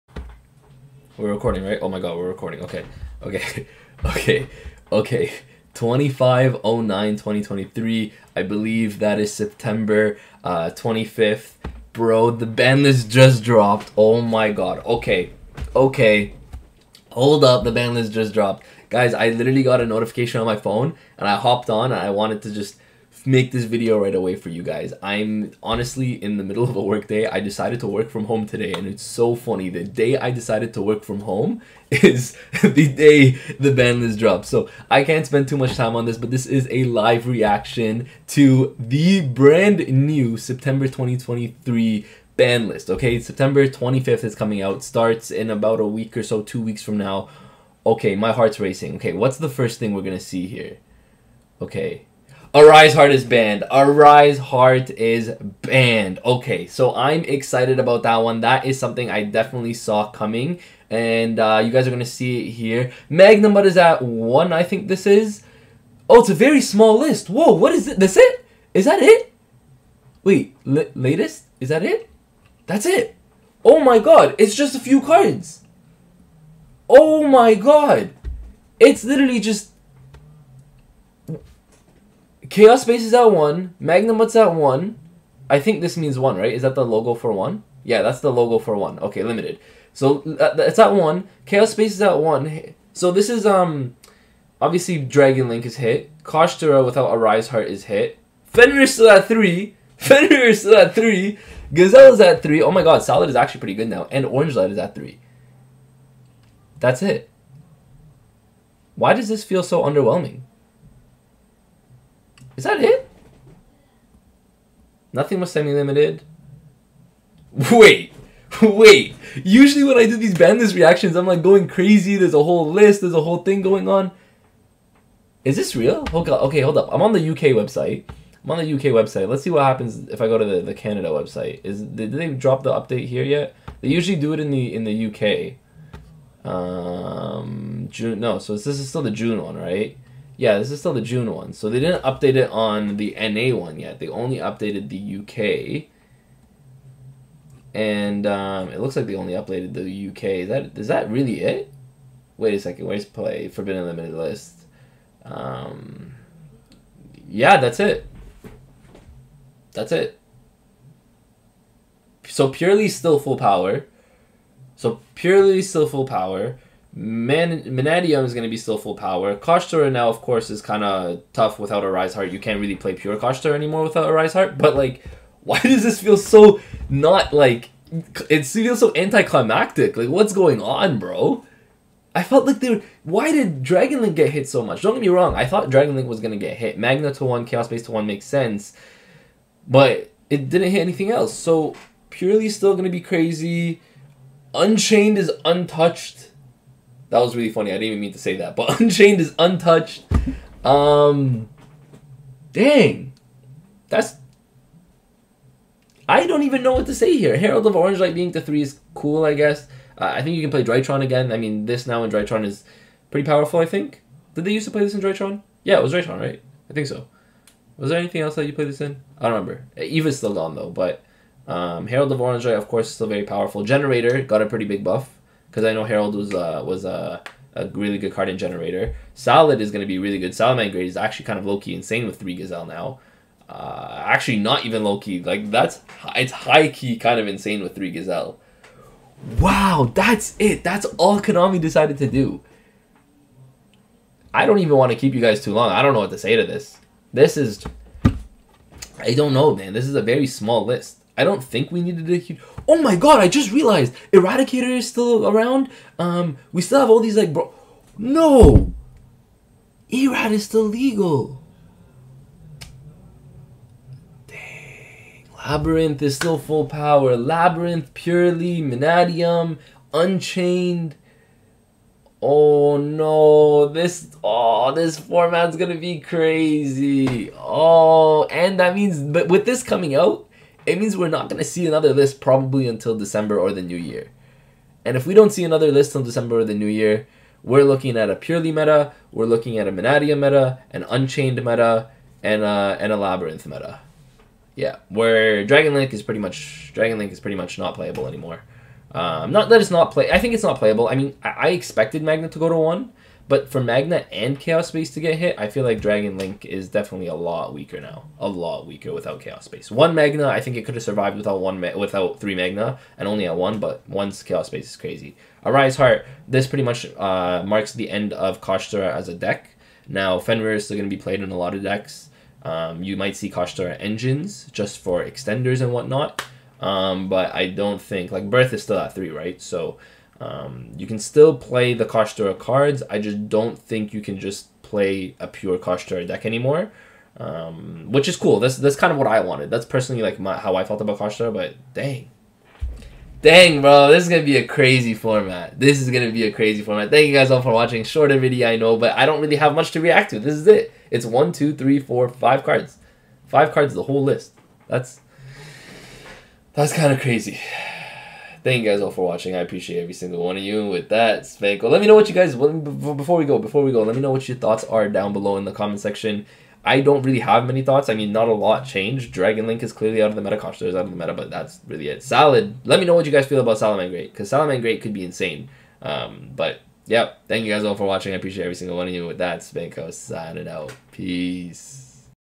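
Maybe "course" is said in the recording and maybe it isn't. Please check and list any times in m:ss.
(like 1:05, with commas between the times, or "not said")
2:50, 3:42.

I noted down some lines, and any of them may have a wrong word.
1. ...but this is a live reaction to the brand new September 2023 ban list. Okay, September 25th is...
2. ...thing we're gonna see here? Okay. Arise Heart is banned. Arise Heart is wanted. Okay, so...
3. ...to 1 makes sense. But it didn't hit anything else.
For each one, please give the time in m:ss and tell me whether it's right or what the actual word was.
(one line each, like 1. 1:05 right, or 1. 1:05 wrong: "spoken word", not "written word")
1. 0:36 right
2. 0:49 wrong: "banned", not "wanted"
3. 3:07 right.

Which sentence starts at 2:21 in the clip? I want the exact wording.
So they didn't update it on the NA one yet.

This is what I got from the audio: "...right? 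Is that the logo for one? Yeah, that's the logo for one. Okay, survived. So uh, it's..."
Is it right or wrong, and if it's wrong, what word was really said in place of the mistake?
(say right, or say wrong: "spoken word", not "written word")
wrong: "limited", not "survived".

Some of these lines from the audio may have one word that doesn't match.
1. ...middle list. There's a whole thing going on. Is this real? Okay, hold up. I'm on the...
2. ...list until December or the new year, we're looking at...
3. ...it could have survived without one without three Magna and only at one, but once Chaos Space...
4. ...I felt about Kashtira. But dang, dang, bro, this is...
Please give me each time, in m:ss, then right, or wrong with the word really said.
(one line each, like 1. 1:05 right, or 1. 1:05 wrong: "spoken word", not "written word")
1. 2:02 wrong: "whole", not "middle"
2. 4:45 right
3. 5:10 right
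4. 5:40 right.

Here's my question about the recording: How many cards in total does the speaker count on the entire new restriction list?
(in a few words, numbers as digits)
5.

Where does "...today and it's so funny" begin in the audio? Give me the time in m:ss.
0:28.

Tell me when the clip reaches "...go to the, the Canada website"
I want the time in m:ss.
2:10.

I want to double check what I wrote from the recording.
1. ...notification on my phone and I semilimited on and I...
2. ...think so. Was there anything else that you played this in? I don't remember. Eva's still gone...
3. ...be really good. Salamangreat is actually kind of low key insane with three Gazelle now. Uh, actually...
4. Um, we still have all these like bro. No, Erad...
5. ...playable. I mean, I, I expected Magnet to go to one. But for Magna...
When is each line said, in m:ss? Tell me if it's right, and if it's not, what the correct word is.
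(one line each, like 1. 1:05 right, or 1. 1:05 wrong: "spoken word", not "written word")
1. 0:19 wrong: "hopped", not "semilimited"
2. 3:36 right
3. 3:49 right
4. 4:15 right
5. 5:00 right.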